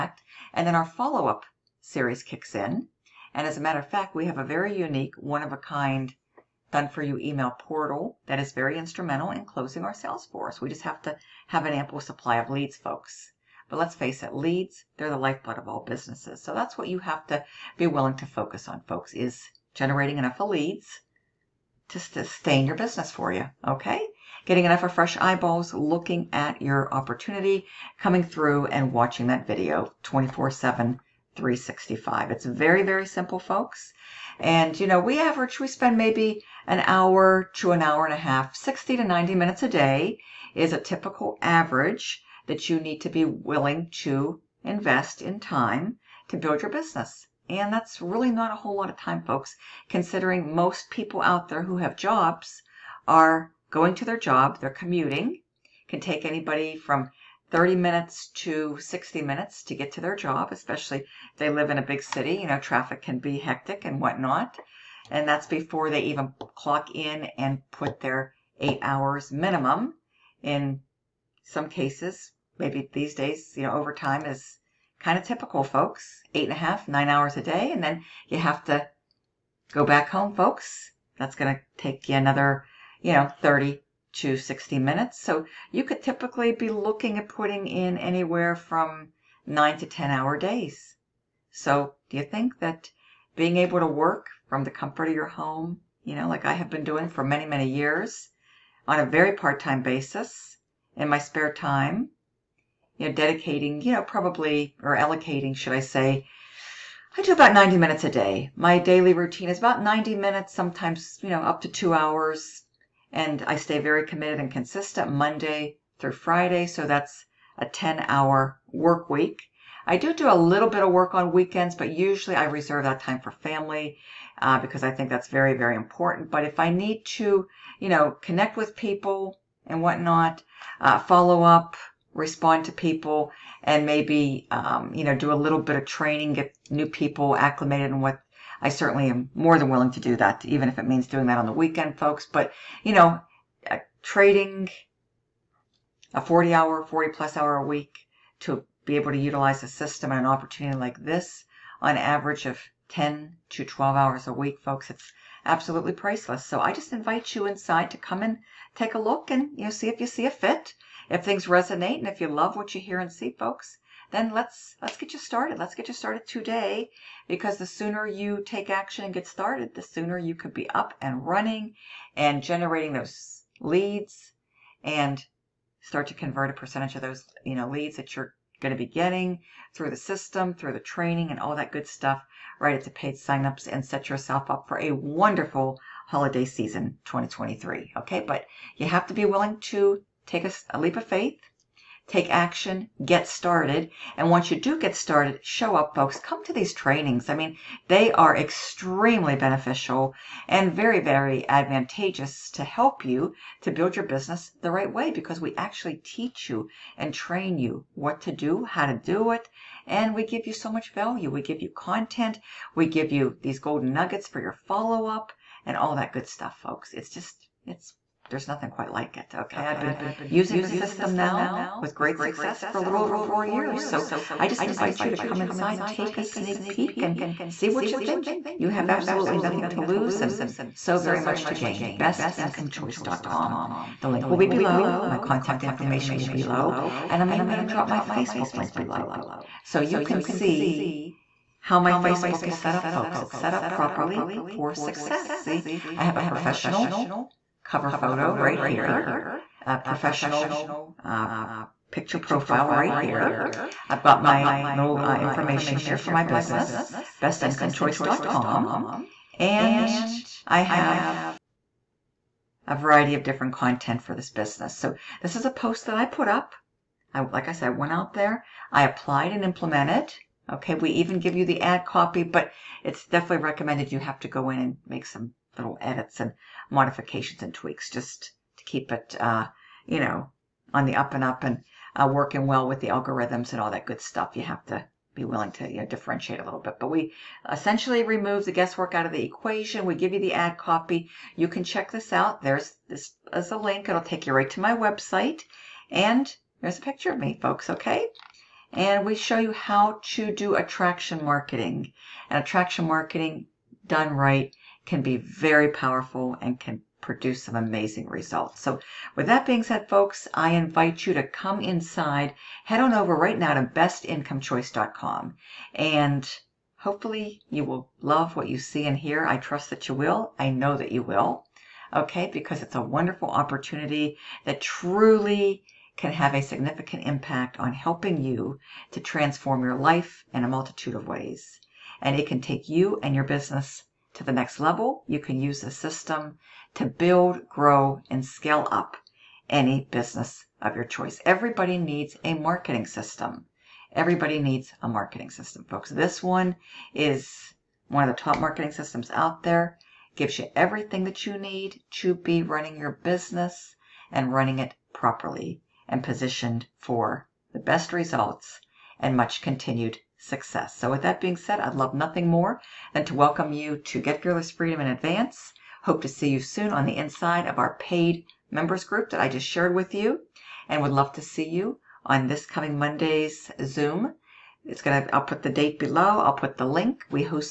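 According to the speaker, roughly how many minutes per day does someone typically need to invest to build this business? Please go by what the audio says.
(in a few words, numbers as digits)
60 to 90 minutes.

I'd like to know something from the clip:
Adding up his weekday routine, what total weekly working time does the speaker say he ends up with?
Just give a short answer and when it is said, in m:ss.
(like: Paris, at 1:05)
10 hours, at 1:57.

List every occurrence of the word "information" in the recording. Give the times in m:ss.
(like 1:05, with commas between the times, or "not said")
3:55, 4:15.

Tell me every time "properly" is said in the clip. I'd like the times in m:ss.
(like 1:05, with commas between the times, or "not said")
4:03, 5:54.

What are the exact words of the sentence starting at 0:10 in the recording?
We just have to have an ample supply of leads, folks.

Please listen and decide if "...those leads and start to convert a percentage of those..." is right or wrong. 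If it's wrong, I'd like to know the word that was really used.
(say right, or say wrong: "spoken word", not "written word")
right.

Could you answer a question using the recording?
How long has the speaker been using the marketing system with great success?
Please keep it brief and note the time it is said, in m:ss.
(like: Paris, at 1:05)
A little over 4 years, at 3:42.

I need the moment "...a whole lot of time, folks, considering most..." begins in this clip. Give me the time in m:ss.
0:48.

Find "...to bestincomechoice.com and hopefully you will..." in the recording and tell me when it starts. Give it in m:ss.
5:13.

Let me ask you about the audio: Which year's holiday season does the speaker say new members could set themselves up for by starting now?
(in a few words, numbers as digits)
2023.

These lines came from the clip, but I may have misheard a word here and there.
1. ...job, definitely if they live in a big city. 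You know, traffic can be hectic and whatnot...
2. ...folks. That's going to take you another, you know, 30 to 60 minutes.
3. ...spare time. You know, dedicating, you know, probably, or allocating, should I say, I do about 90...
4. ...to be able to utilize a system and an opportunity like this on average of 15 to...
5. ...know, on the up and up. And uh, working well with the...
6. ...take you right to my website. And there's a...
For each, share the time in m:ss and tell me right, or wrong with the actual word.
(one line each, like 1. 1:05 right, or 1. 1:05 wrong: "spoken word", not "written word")
1. 1:00 wrong: "especially", not "definitely"
2. 1:20 right
3. 1:41 right
4. 2:28 wrong: "10", not "15"
5. 4:39 right
6. 4:54 right.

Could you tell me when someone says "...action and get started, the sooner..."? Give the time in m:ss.
2:48.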